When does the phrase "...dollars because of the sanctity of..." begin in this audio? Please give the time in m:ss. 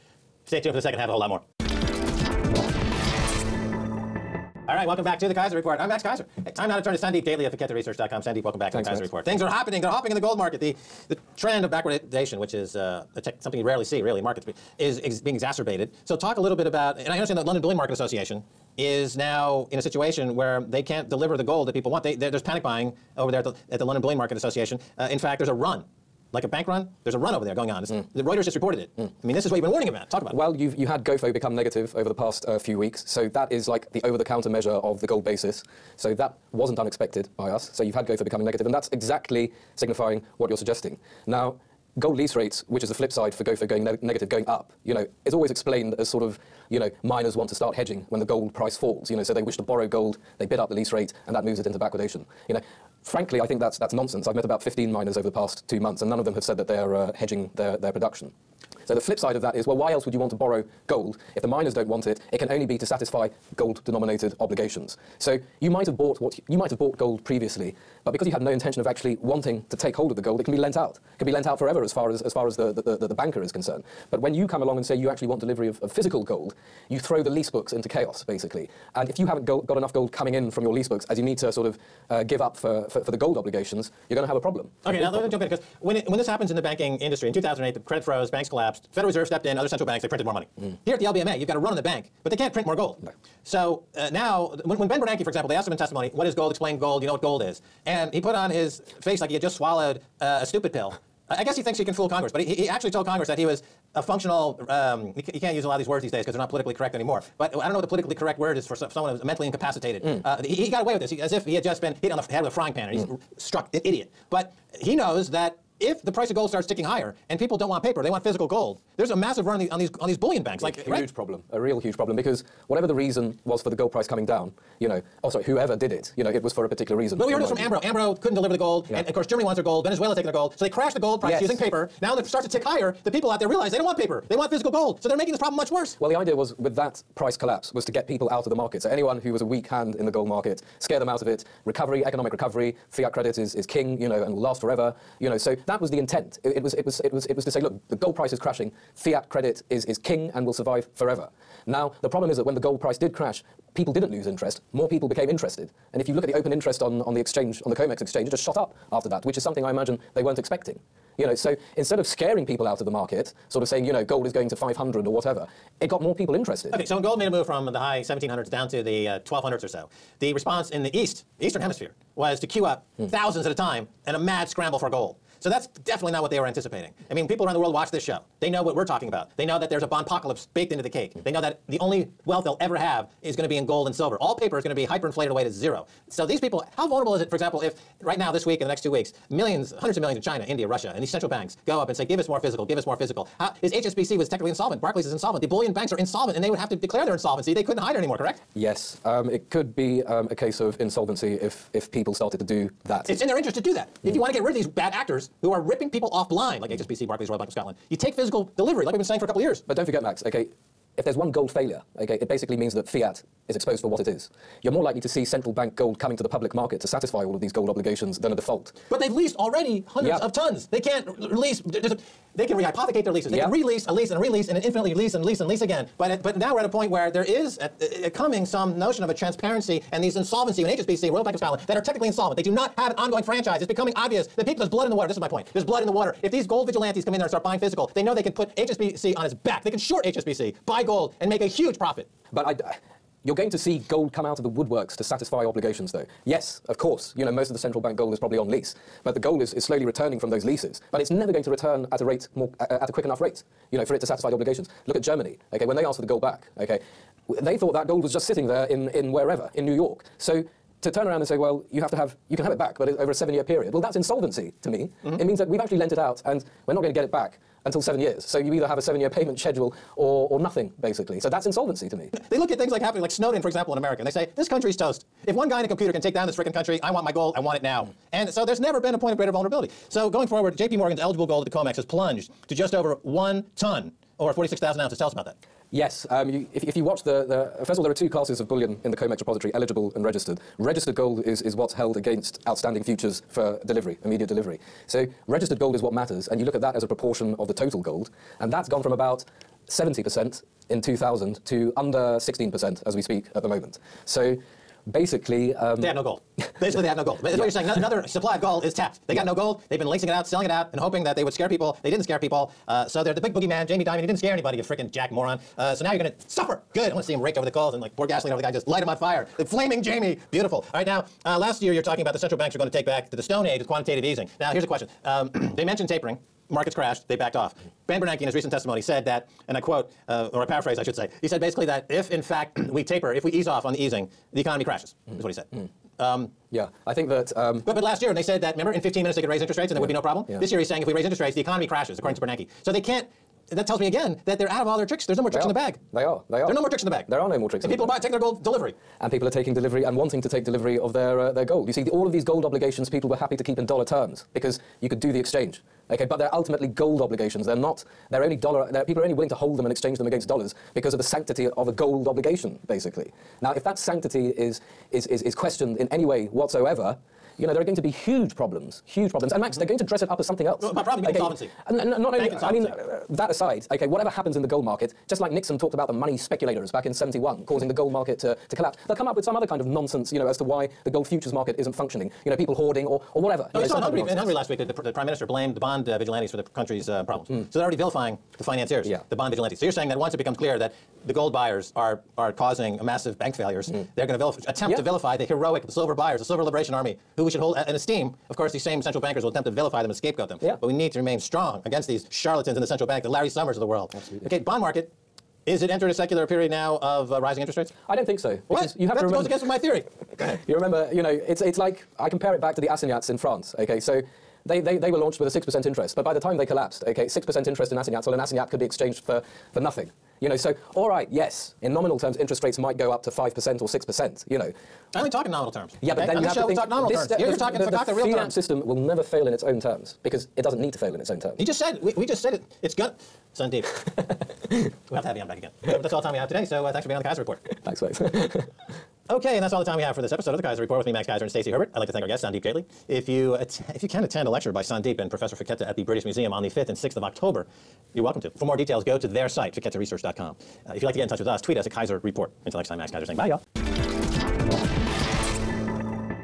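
6:00.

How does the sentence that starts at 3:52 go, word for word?
They do not have an ongoing franchise.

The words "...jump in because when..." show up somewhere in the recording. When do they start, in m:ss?
1:25.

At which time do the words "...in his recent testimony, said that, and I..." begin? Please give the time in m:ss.
5:28.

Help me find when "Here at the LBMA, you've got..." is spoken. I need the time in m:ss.
1:30.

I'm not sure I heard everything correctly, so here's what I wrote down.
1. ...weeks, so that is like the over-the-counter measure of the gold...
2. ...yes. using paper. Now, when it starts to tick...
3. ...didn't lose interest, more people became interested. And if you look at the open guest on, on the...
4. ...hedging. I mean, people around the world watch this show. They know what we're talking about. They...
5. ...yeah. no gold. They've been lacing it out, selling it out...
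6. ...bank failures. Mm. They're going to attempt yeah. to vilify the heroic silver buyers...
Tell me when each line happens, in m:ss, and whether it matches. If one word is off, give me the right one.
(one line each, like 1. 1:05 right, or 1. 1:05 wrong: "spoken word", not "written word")
1. 0:32 right
2. 2:11 right
3. 2:33 wrong: "interest", not "guest"
4. 2:56 wrong: "anticipating", not "hedging"
5. 5:09 right
6. 6:33 right.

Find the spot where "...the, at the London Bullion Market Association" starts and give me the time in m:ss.
0:23.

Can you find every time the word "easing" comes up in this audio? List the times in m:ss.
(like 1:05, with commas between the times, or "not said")
5:24, 5:33.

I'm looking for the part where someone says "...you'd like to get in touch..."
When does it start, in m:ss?
7:30.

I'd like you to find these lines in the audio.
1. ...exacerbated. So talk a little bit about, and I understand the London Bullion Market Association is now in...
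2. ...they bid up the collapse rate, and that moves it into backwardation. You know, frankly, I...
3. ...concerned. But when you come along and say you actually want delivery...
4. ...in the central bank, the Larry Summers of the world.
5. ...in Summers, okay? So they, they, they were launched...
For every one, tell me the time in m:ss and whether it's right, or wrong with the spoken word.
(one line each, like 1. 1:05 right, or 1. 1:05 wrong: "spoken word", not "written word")
1. 0:15 right
2. 0:50 wrong: "lease", not "collapse"
3. 1:13 right
4. 6:42 right
5. 6:53 wrong: "France", not "Summers".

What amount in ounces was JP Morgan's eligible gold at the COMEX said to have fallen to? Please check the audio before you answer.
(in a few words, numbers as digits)
46,000 ounces.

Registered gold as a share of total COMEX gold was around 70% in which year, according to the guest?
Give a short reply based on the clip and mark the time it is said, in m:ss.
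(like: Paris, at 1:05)
2000, at 5:00.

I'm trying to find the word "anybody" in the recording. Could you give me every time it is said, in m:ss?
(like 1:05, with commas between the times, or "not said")
5:14.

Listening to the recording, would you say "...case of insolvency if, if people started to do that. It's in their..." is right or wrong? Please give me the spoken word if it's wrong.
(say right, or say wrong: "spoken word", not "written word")
right.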